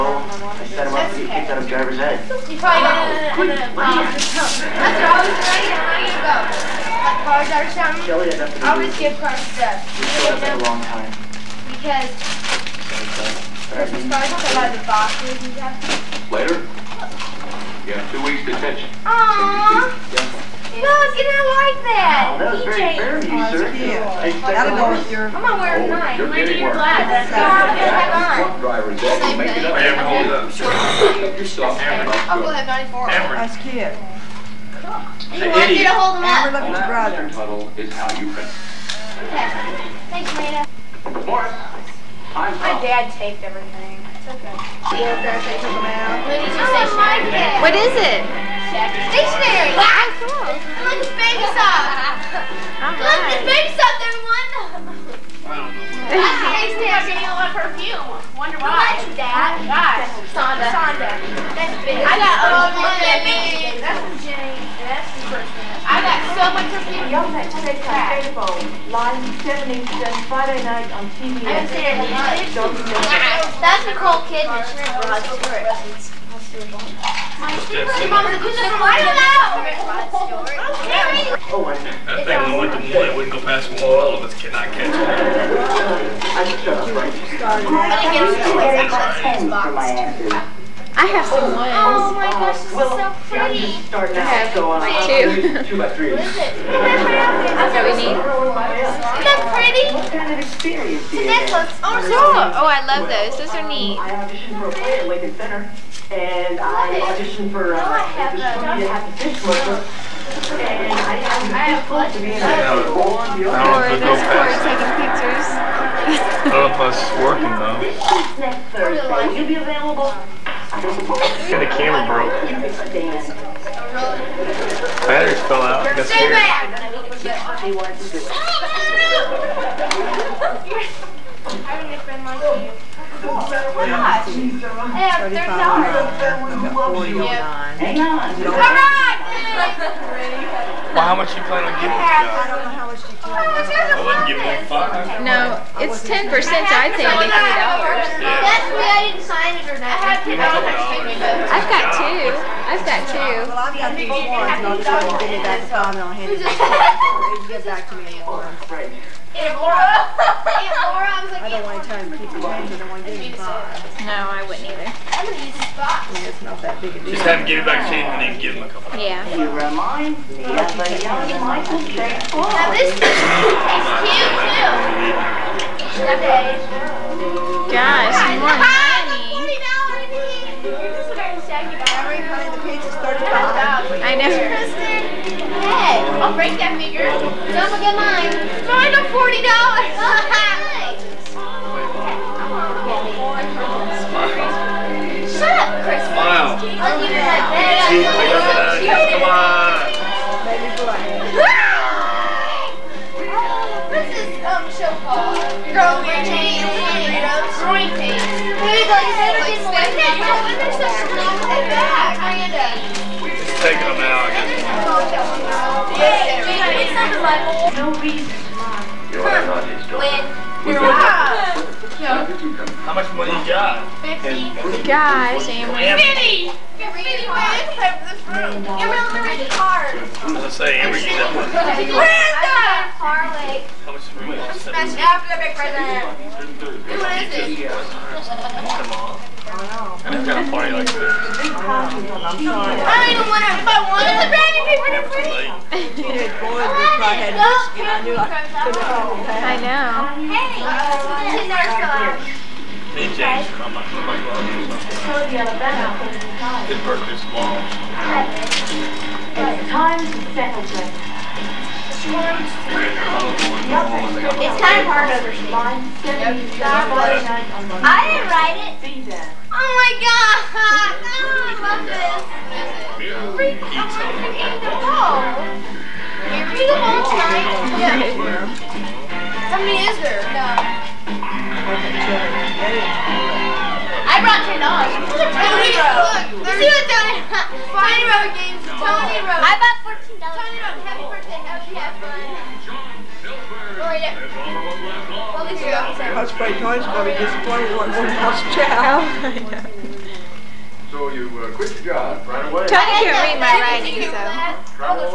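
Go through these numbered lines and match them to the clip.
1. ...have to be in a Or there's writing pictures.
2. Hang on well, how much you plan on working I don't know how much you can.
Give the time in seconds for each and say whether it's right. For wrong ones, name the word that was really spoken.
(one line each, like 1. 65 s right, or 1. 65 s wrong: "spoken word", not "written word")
1. 111 s wrong: "taking", not "writing"
2. 137 s wrong: "giving", not "working".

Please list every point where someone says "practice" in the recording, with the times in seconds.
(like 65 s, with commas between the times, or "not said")
not said.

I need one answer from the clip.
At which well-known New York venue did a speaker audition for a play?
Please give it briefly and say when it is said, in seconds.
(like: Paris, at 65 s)
Lincoln Center, at 105 s.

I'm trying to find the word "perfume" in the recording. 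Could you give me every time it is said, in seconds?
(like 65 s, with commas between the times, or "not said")
57 s, 66 s.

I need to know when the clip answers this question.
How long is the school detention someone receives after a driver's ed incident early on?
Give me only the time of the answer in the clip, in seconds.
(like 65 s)
18 s.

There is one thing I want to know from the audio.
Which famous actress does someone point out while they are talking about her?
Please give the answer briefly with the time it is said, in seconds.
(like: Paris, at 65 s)
Nicole Kidman, at 73 s.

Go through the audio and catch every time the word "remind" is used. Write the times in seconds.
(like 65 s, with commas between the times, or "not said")
169 s.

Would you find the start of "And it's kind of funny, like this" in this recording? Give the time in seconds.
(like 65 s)
239 s.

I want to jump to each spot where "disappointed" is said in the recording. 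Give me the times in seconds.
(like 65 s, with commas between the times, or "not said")
297 s.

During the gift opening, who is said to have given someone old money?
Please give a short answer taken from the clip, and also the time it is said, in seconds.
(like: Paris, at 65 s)
Jane, at 64 s.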